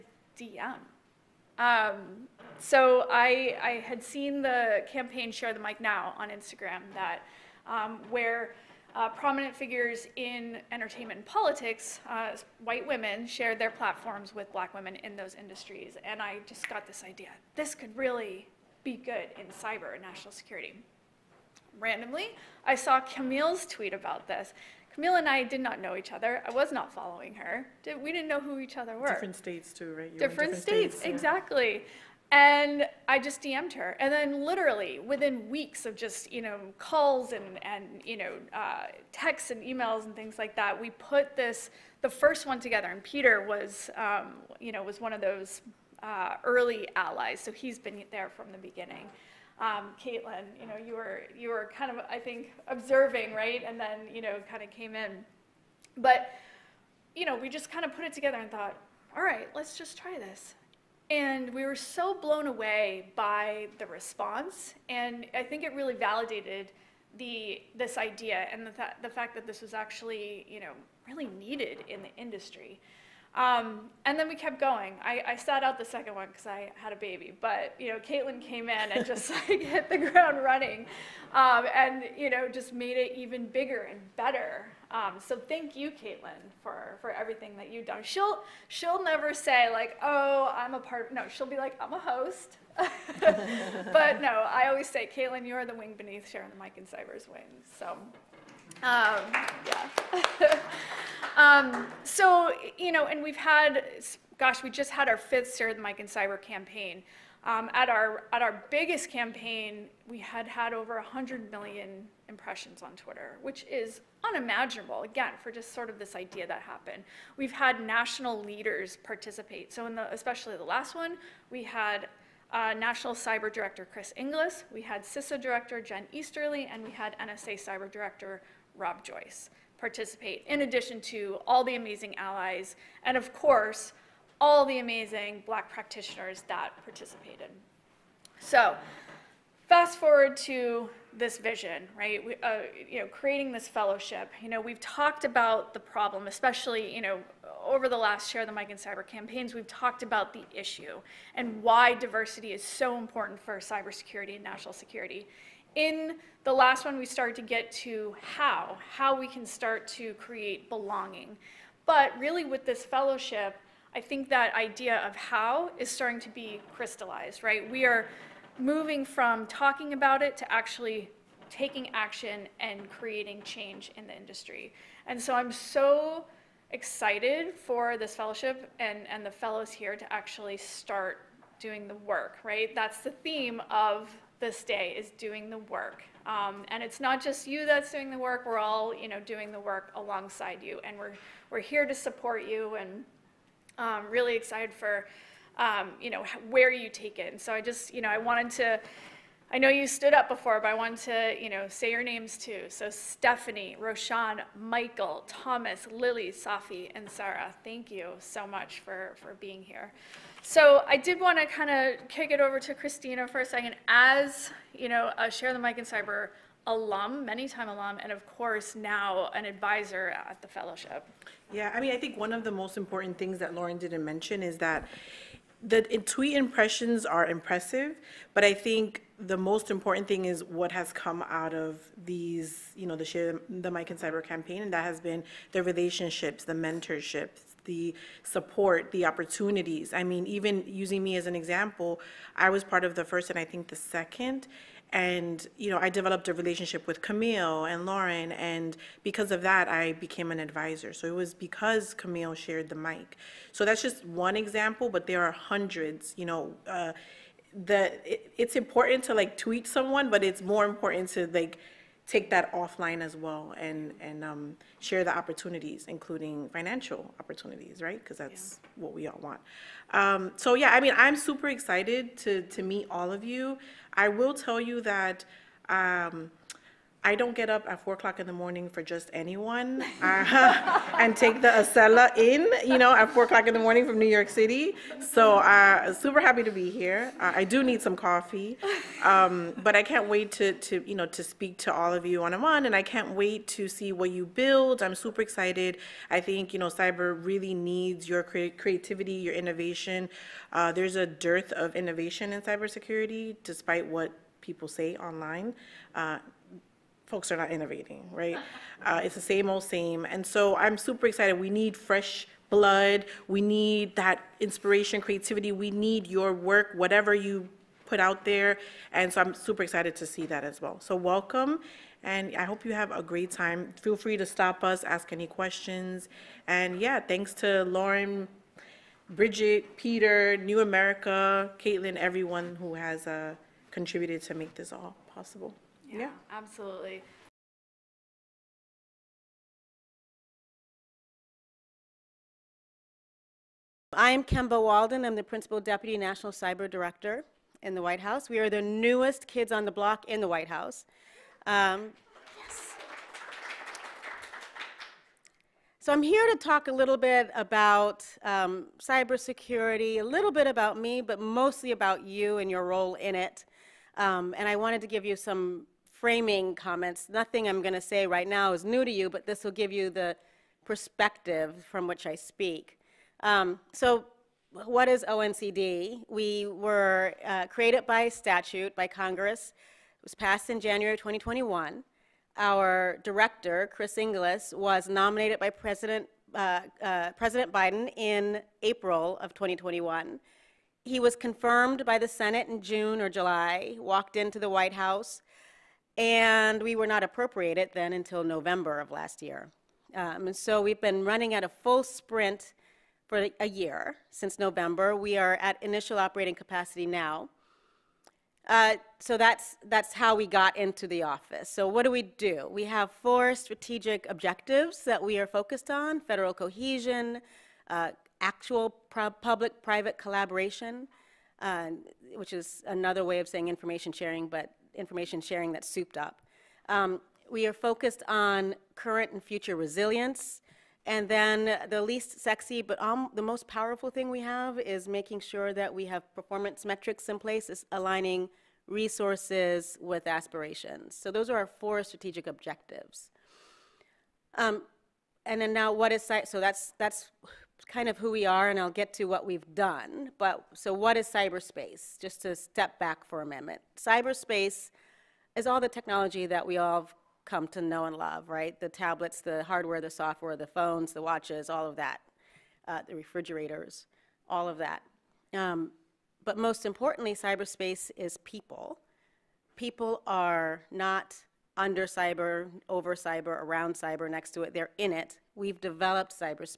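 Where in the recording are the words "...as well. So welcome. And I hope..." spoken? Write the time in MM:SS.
05:20.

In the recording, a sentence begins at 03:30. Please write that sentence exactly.
So I did want to kind of kick it over to Christina for a second.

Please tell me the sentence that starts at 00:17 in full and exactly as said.
This could really be good in cyber and national security.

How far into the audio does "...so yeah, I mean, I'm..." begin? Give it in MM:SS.
04:30.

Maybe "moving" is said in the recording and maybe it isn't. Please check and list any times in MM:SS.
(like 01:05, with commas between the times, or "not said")
02:48.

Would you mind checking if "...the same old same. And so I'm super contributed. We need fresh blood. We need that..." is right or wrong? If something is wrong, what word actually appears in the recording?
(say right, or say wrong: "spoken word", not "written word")
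wrong: "excited", not "contributed".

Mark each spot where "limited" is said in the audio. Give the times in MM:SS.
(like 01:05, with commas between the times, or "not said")
not said.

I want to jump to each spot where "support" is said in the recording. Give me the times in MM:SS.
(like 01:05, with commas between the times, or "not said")
03:11, 03:58.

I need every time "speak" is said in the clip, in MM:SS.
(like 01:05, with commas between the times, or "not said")
04:51, 06:12.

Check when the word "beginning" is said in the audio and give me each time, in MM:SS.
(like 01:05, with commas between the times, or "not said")
00:48.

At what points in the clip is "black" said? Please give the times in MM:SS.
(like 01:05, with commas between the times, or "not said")
00:14, 02:15.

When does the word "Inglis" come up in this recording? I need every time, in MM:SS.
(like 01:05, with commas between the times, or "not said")
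02:04, 06:23.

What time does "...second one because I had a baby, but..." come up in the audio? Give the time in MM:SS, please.
01:15.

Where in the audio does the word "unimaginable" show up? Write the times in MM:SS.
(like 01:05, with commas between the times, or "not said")
01:54.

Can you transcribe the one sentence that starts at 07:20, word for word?
So those are our four strategic objectives.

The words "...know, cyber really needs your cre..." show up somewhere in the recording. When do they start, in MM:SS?
04:56.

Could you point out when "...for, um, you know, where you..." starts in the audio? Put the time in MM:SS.
03:14.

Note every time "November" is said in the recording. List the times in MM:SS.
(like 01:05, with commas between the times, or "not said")
06:38, 06:44.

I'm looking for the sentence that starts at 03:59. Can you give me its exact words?
I mean, even using me as an example, I was part of the first and I think the second.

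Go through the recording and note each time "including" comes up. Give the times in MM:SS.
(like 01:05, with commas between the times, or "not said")
04:25.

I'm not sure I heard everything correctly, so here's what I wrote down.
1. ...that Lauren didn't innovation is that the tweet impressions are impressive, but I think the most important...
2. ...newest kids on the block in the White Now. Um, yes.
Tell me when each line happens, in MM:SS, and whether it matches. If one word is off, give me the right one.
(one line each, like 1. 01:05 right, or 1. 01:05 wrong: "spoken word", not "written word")
1. 03:43 wrong: "mention", not "innovation"
2. 05:48 wrong: "House", not "Now".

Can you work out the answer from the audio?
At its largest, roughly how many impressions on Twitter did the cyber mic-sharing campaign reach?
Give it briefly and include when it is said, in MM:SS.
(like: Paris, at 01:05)
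over 100 million, at 01:50.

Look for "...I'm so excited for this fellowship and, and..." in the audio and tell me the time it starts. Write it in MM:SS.
02:55.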